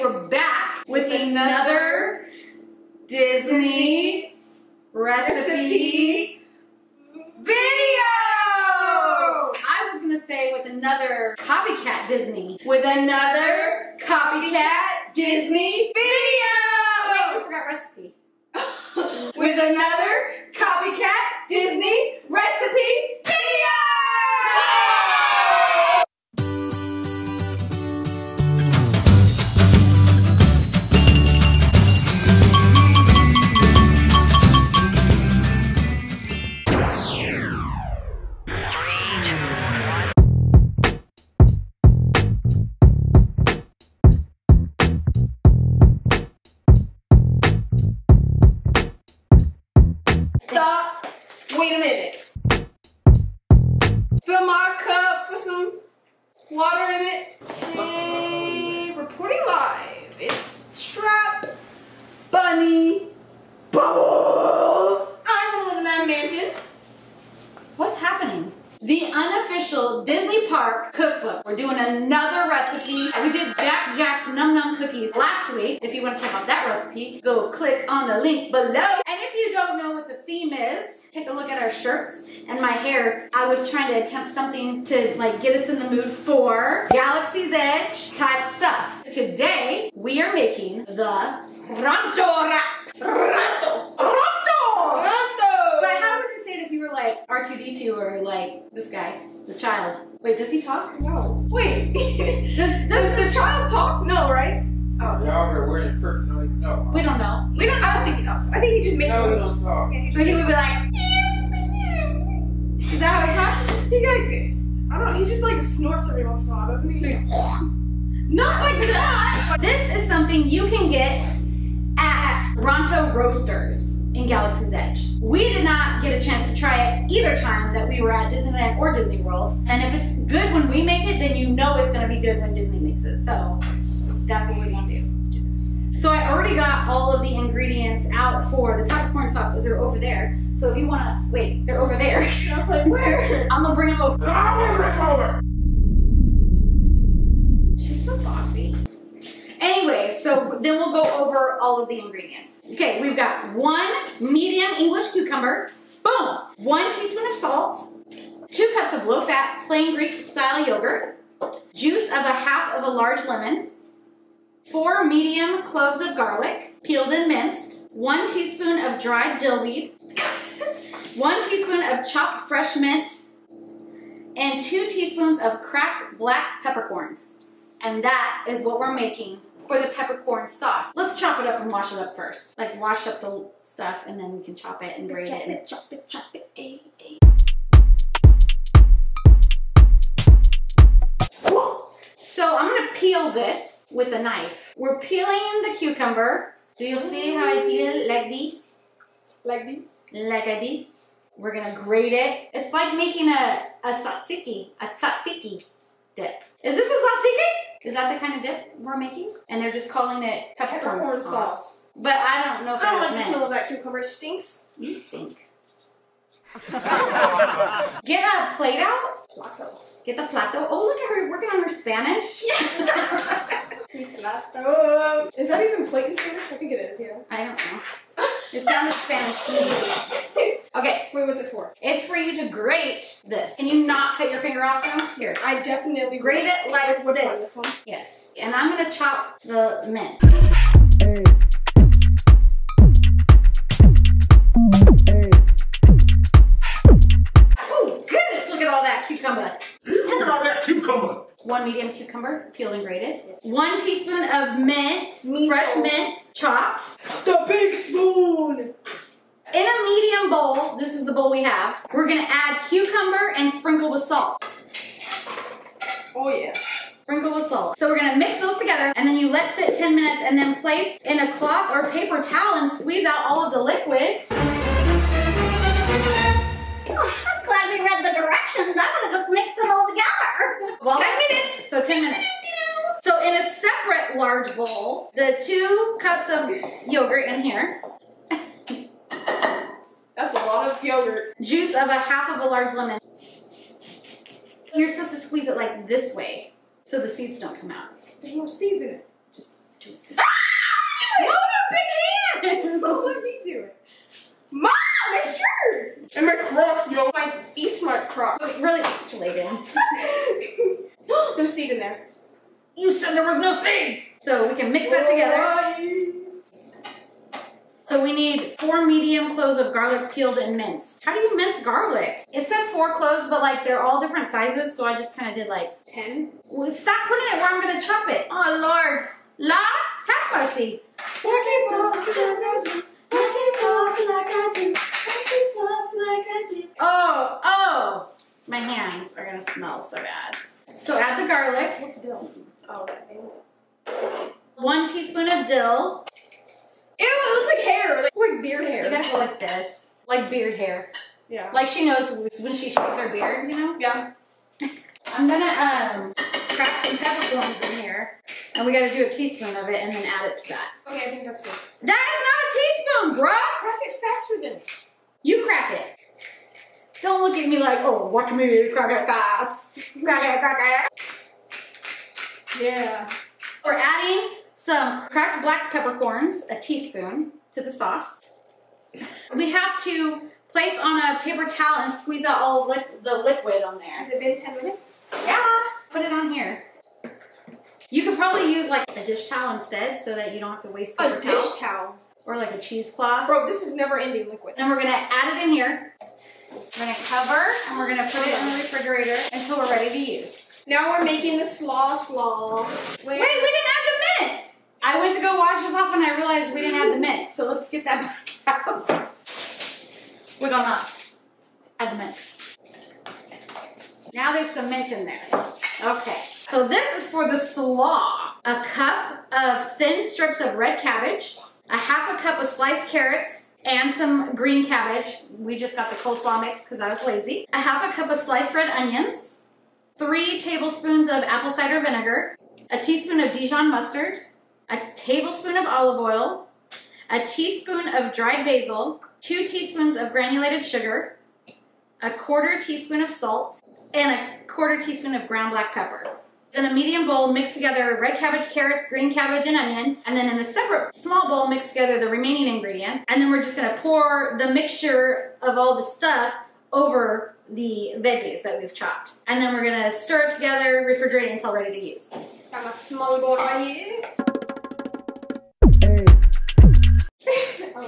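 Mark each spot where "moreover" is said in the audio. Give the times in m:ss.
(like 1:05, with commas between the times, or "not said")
not said.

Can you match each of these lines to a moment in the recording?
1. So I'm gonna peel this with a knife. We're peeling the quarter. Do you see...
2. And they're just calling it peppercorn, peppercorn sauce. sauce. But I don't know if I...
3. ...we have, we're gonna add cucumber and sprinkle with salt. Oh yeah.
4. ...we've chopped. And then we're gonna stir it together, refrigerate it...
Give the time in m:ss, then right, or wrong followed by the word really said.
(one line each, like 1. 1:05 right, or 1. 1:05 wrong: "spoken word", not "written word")
1. 3:12 wrong: "cucumber", not "quarter"
2. 3:29 right
3. 4:21 right
4. 7:38 right.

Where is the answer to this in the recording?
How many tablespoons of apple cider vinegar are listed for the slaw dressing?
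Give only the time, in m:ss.
7:09.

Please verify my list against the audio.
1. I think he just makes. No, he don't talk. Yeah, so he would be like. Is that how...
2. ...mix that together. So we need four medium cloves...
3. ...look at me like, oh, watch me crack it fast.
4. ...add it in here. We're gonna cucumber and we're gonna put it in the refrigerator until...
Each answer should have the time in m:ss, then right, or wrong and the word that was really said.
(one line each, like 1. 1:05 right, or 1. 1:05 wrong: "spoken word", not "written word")
1. 1:48 right
2. 5:14 right
3. 6:07 right
4. 6:34 wrong: "cover", not "cucumber".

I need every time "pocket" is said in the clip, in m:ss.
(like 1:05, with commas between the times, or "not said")
not said.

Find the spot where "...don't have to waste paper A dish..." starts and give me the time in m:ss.
6:30.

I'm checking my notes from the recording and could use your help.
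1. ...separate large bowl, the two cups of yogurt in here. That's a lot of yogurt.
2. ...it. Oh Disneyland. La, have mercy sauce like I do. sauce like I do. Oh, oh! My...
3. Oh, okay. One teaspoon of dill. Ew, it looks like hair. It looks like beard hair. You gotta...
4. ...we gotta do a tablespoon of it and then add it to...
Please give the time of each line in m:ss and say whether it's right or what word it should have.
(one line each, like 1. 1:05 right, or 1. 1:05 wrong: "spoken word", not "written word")
1. 4:43 right
2. 5:28 wrong: "Lord", not "Disneyland"
3. 5:42 right
4. 5:58 wrong: "teaspoon", not "tablespoon".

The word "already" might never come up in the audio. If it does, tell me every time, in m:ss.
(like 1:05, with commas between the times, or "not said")
2:16.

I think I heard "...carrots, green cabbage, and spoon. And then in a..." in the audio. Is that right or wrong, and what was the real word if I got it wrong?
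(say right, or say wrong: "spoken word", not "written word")
wrong: "onion", not "spoon".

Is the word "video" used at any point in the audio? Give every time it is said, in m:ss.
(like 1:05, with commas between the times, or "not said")
0:07, 0:15.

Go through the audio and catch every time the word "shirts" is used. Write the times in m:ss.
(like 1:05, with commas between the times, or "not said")
1:21, 5:05.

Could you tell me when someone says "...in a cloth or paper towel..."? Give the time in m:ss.
4:31.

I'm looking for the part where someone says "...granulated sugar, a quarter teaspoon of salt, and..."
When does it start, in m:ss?
7:20.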